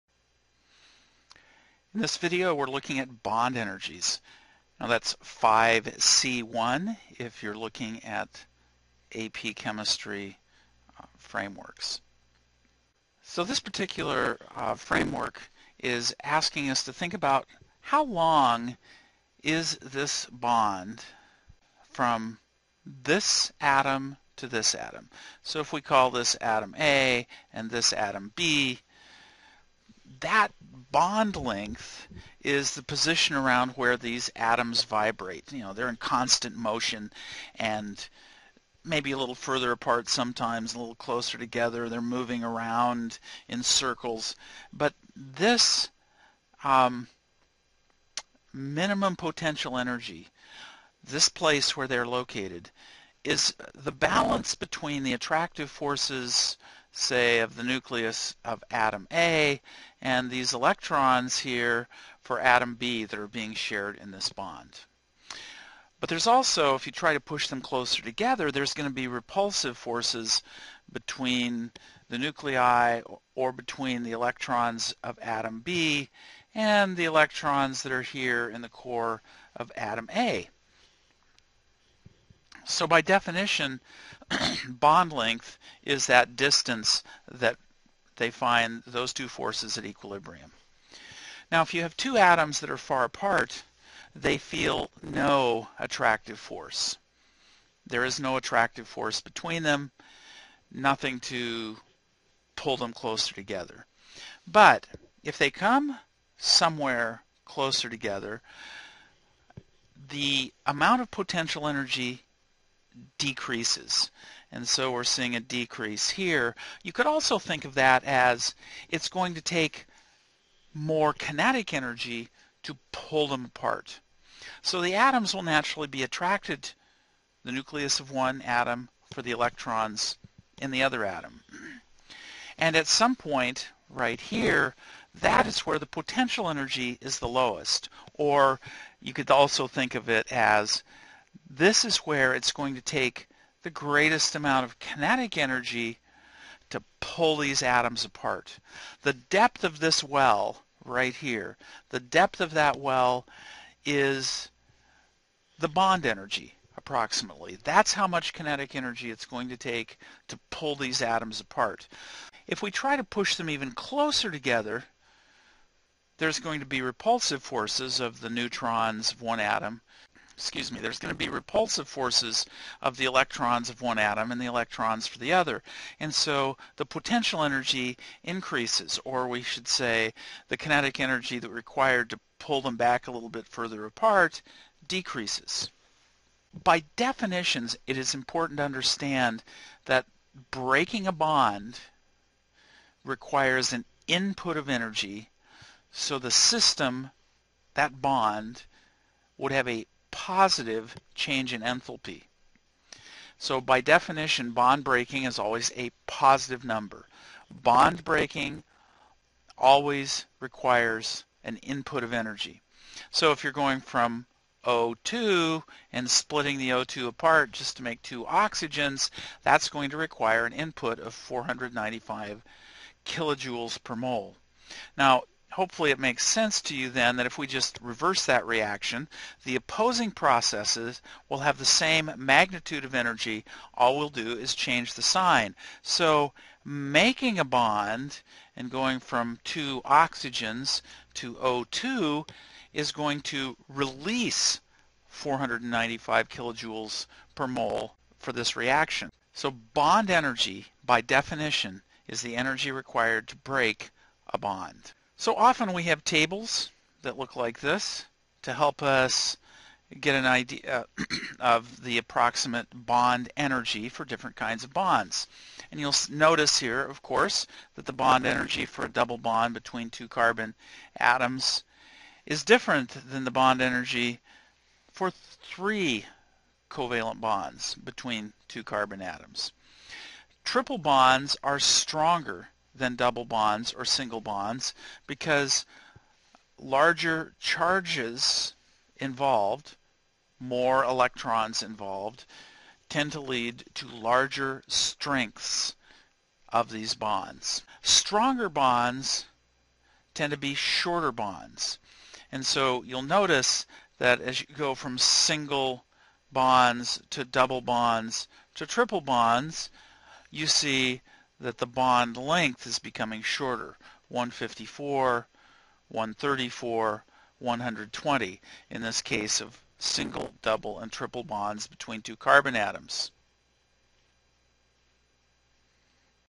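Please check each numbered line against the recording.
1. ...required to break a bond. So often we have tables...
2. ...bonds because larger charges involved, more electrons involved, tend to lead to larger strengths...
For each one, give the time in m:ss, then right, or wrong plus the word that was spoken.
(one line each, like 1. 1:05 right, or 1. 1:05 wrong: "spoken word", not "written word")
1. 4:12 right
2. 4:44 right.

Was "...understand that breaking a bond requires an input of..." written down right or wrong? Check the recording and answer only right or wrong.
right.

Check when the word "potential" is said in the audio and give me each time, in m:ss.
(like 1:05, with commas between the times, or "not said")
0:49, 1:51, 2:15, 2:56.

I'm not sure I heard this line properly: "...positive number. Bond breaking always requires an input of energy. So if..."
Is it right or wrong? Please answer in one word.
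right.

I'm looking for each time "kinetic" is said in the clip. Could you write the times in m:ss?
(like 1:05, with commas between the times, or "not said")
2:01, 2:24, 2:38, 3:00.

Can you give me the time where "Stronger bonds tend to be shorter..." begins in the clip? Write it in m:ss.
4:57.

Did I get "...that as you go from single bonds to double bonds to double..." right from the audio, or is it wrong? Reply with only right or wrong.
wrong.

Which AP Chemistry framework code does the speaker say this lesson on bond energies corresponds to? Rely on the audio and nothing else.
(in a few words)
5C1.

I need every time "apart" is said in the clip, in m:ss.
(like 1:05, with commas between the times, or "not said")
0:39, 1:33, 2:03, 2:28, 2:41, 3:03, 3:37.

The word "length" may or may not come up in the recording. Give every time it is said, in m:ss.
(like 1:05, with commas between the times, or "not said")
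0:31, 1:25, 5:12.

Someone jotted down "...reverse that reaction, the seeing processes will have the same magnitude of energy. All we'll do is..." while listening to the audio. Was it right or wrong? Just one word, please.
wrong.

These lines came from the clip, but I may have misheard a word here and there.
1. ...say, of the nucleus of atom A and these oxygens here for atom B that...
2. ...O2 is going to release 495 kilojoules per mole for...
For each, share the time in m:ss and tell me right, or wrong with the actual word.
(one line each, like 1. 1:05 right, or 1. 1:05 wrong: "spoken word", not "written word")
1. 0:56 wrong: "electrons", not "oxygens"
2. 4:01 right.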